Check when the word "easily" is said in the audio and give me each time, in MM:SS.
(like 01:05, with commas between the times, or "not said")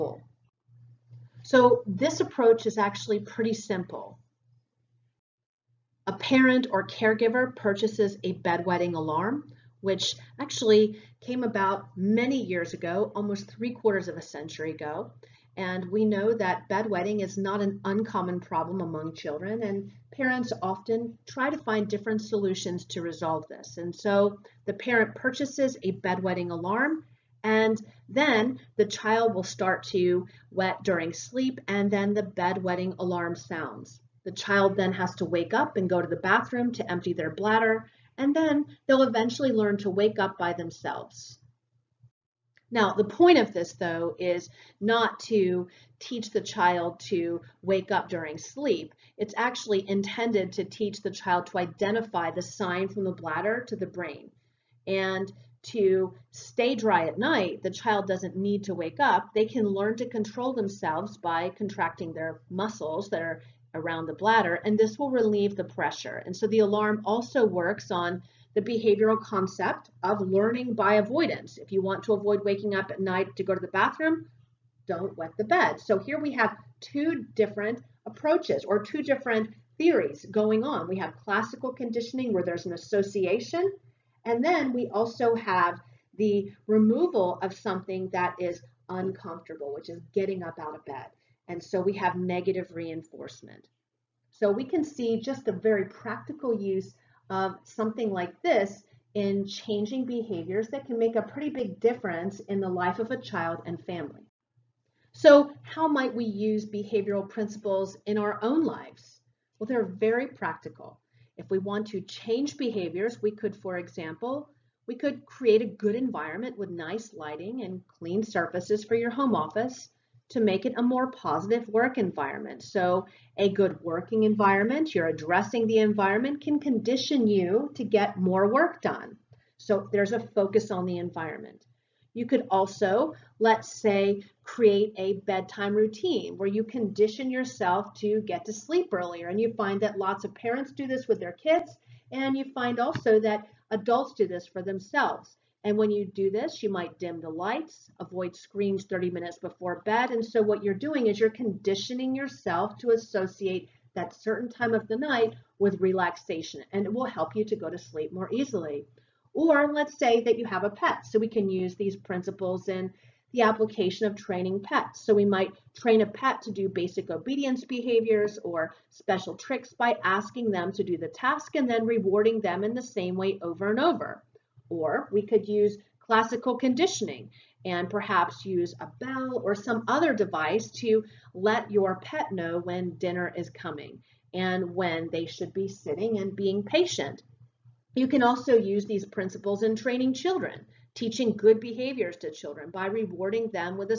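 02:38.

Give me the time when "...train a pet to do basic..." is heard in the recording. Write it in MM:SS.
02:45.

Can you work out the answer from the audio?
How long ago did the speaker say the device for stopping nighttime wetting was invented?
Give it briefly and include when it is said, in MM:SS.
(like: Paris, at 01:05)
almost three quarters of a century, at 00:13.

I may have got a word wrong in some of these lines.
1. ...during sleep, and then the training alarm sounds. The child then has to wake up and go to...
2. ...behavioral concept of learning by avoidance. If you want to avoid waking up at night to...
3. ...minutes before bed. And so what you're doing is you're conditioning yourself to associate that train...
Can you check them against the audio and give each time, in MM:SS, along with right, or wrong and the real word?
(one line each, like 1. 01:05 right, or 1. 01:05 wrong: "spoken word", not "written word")
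1. 00:30 wrong: "bedwetting", not "training"
2. 01:08 right
3. 02:29 wrong: "certain", not "train".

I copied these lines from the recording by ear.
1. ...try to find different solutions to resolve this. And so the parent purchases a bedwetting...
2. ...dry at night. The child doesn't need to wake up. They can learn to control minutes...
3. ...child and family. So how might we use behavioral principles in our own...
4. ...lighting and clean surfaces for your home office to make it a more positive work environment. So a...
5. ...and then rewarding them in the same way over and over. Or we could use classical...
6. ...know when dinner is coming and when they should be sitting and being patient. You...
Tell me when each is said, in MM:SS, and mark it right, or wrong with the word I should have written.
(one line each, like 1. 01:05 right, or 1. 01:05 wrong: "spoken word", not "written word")
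1. 00:21 right
2. 00:56 wrong: "themselves", not "minutes"
3. 01:43 right
4. 01:57 right
5. 02:51 right
6. 03:02 right.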